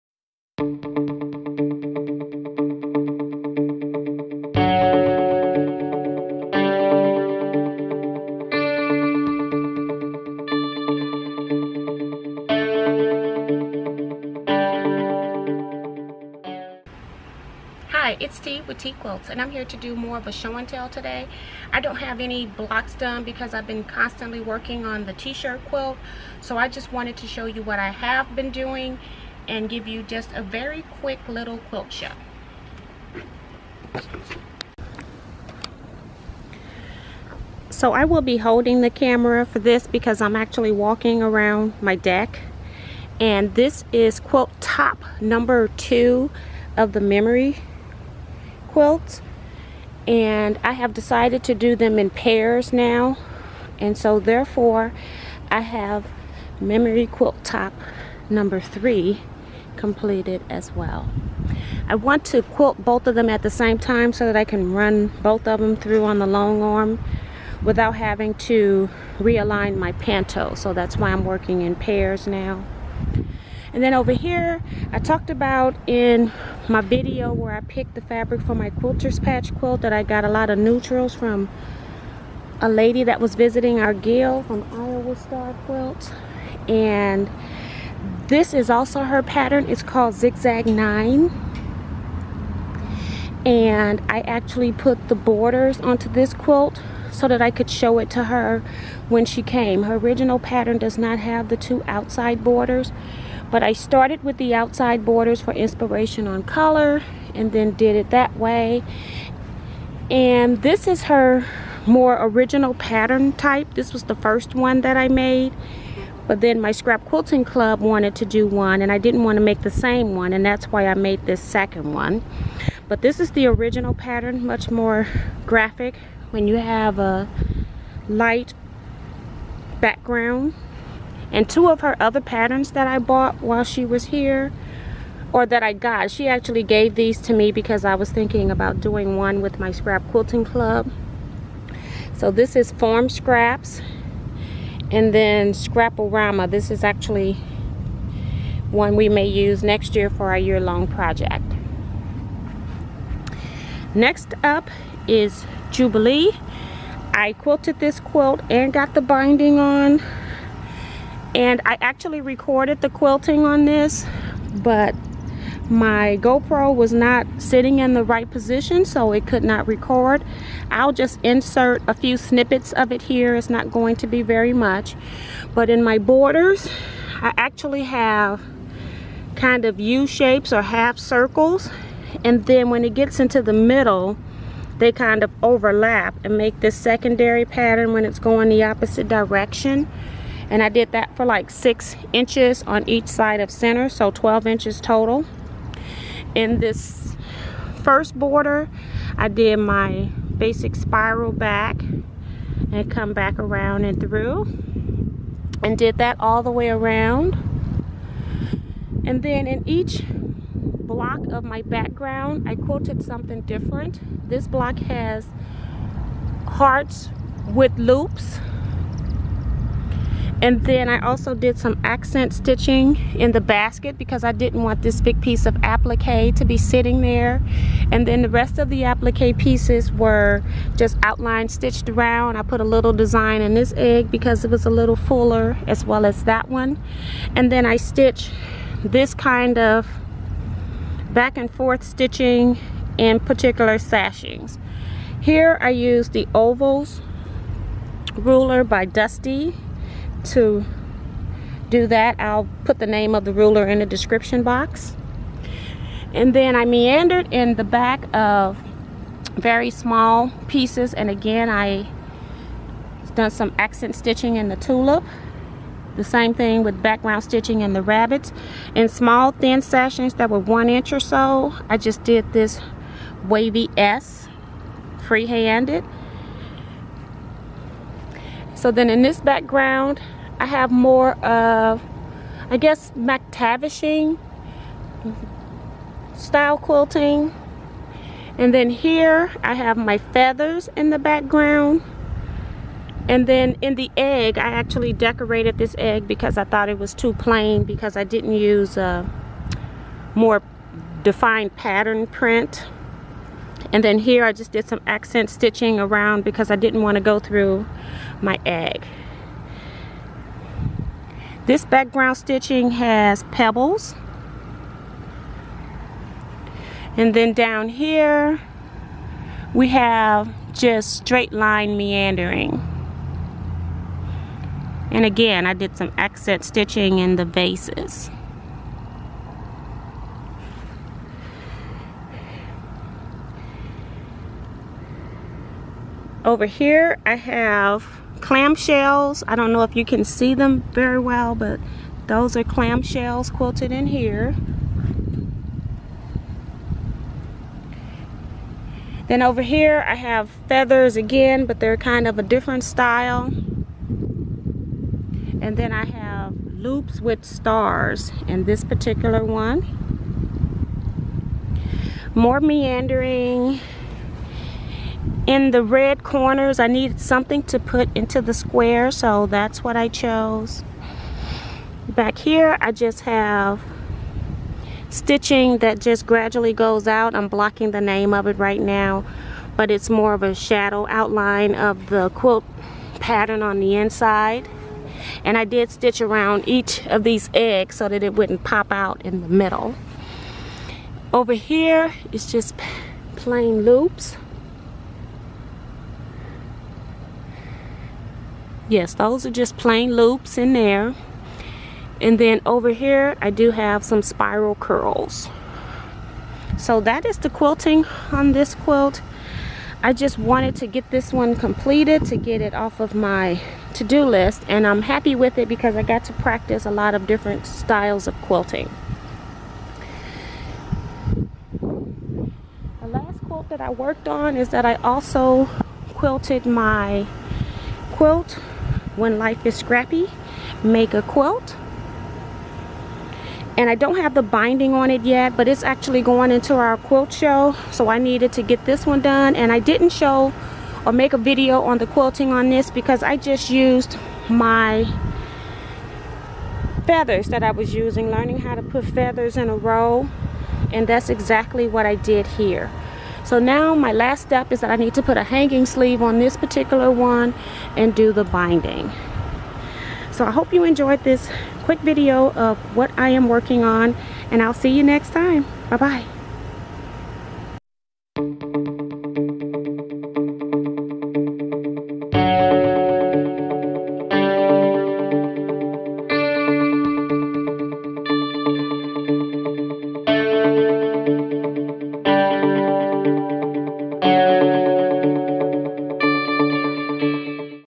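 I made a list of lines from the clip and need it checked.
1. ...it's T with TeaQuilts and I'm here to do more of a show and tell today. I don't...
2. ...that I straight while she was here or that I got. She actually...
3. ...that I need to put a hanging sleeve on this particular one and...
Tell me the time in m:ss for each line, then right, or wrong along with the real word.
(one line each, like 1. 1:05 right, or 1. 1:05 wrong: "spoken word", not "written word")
1. 0:18 right
2. 2:12 wrong: "bought", not "straight"
3. 7:34 right.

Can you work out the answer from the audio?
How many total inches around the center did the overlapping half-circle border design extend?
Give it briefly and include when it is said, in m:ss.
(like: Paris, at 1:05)
12 inches, at 3:14.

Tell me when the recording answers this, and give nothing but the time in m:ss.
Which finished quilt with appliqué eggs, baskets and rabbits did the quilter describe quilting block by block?
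2:35.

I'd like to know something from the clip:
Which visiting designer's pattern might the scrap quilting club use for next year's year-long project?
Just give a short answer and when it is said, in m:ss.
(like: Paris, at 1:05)
Scrapple-Rama, at 2:25.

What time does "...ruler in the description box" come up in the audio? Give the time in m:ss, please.
4:13.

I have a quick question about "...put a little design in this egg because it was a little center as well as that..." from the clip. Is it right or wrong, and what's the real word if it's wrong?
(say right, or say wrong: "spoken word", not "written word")
wrong: "fuller", not "center".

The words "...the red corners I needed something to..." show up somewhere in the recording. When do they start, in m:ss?
6:05.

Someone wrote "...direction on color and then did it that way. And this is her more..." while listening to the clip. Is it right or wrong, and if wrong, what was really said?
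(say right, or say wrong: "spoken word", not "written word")
wrong: "inspiration", not "direction".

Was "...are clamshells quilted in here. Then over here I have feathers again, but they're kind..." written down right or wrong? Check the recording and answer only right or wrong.
right.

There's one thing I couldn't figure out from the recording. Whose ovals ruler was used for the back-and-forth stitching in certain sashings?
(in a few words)
Dusty.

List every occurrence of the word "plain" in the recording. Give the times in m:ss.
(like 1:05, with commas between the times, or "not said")
4:57, 6:33, 6:39.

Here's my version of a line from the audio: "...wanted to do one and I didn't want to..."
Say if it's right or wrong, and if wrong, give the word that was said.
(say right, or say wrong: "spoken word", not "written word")
right.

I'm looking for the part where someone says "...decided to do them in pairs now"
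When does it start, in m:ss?
0:50.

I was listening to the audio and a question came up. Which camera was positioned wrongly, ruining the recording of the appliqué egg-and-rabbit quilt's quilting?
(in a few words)
GoPro.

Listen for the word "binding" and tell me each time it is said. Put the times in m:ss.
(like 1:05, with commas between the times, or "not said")
2:39, 7:14, 7:38.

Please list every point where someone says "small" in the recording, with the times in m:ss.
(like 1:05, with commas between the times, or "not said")
4:19, 4:28.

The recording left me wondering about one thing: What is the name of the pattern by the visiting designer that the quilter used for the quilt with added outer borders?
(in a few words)
Zigzag 9.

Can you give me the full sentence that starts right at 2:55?
But in my borders, I actually have kind of U shapes or half circles.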